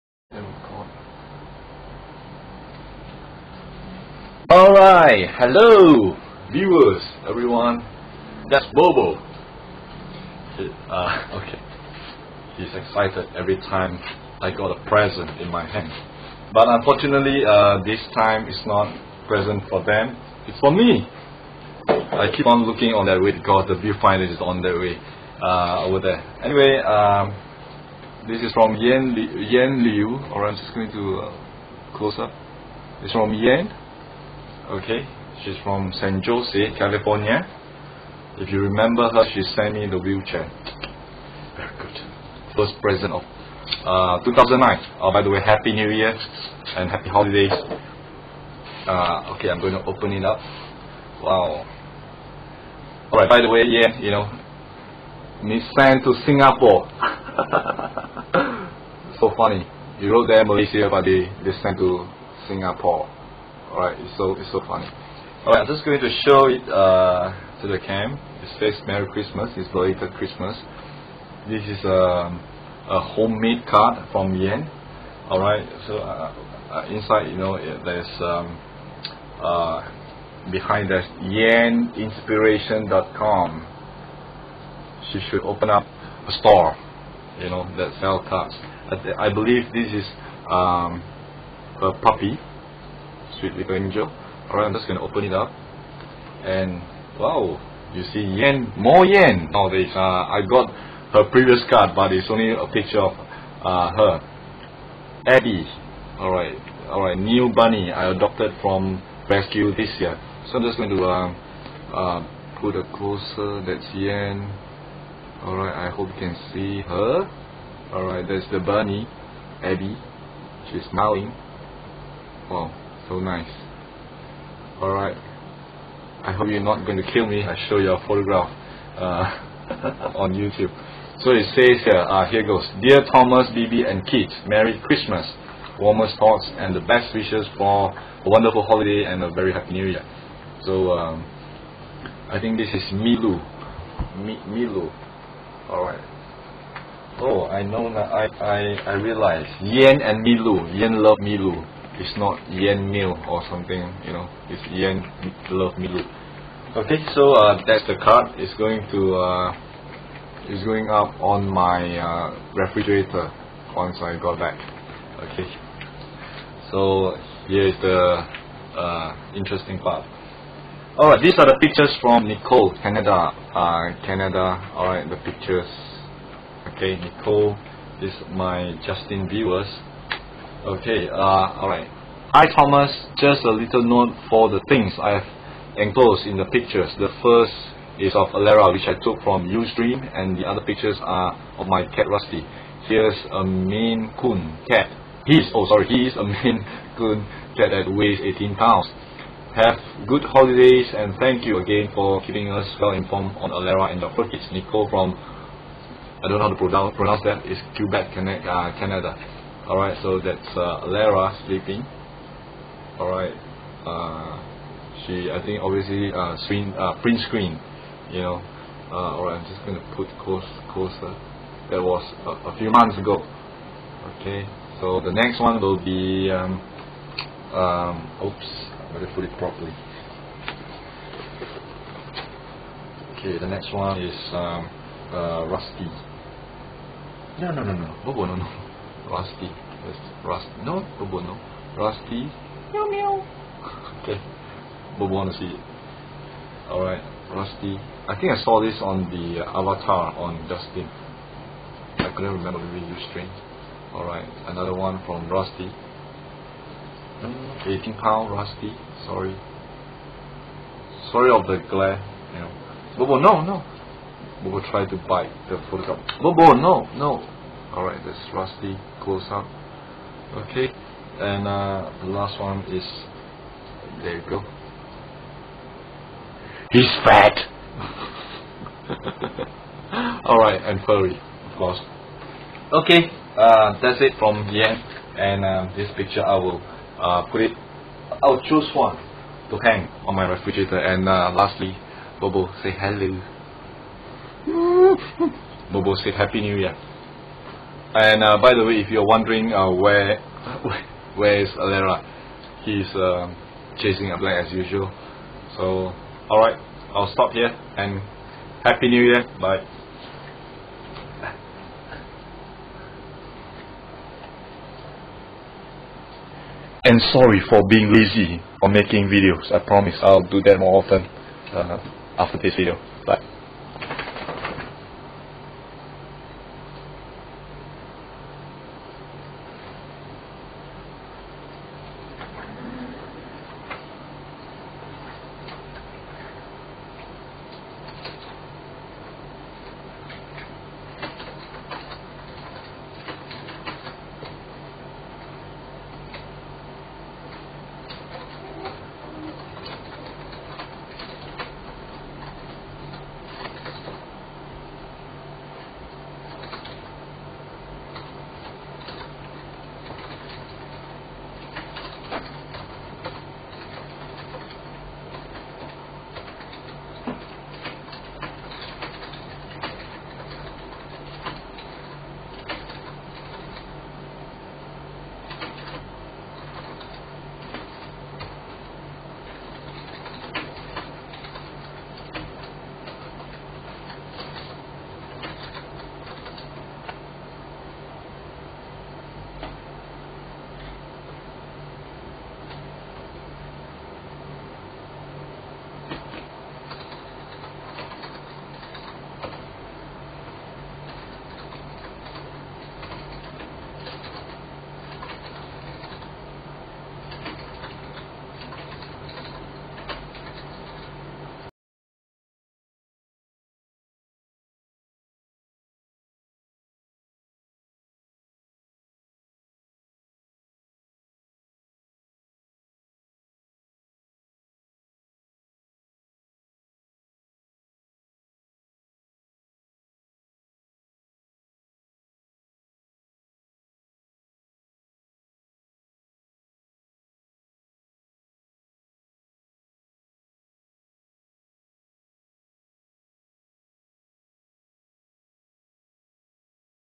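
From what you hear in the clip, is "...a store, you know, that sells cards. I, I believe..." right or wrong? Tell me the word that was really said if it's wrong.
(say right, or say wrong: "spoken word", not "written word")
right.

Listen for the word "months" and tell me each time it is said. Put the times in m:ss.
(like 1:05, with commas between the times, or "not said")
3:42.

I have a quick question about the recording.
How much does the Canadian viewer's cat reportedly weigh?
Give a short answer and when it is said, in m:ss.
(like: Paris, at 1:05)
18 pounds, at 3:18.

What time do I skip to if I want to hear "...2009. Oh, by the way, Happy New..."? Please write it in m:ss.
0:44.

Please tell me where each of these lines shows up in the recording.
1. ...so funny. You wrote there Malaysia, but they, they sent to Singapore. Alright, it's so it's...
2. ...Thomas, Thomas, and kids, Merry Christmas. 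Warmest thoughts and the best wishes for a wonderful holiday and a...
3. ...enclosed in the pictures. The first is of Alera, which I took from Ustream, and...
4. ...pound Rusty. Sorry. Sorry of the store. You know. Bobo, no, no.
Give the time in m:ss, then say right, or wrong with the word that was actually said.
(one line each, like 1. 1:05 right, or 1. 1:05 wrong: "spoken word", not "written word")
1. 0:59 right
2. 2:13 wrong: "Bibi", not "Thomas"
3. 3:05 right
4. 4:17 wrong: "glare", not "store".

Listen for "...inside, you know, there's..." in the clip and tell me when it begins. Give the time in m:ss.
1:16.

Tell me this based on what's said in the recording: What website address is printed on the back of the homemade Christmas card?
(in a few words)
yeninspiration.com.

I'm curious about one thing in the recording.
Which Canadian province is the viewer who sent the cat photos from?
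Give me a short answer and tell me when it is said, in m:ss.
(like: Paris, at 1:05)
Quebec, at 3:27.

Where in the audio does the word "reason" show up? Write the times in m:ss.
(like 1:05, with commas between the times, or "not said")
not said.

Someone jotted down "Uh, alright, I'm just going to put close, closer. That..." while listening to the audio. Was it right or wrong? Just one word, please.
right.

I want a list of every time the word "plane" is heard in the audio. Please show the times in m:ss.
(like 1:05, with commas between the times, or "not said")
5:04.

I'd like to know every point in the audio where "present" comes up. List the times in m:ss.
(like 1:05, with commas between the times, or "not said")
0:14, 0:19, 0:42.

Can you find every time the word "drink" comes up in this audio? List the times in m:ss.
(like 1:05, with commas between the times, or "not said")
not said.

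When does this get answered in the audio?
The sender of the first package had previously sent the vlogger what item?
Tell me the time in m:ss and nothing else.
0:39.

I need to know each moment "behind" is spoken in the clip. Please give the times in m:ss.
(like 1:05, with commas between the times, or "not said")
1:20.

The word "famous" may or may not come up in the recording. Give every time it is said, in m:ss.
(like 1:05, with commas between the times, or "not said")
not said.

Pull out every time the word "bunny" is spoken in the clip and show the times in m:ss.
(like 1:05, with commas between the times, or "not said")
1:47, 1:58.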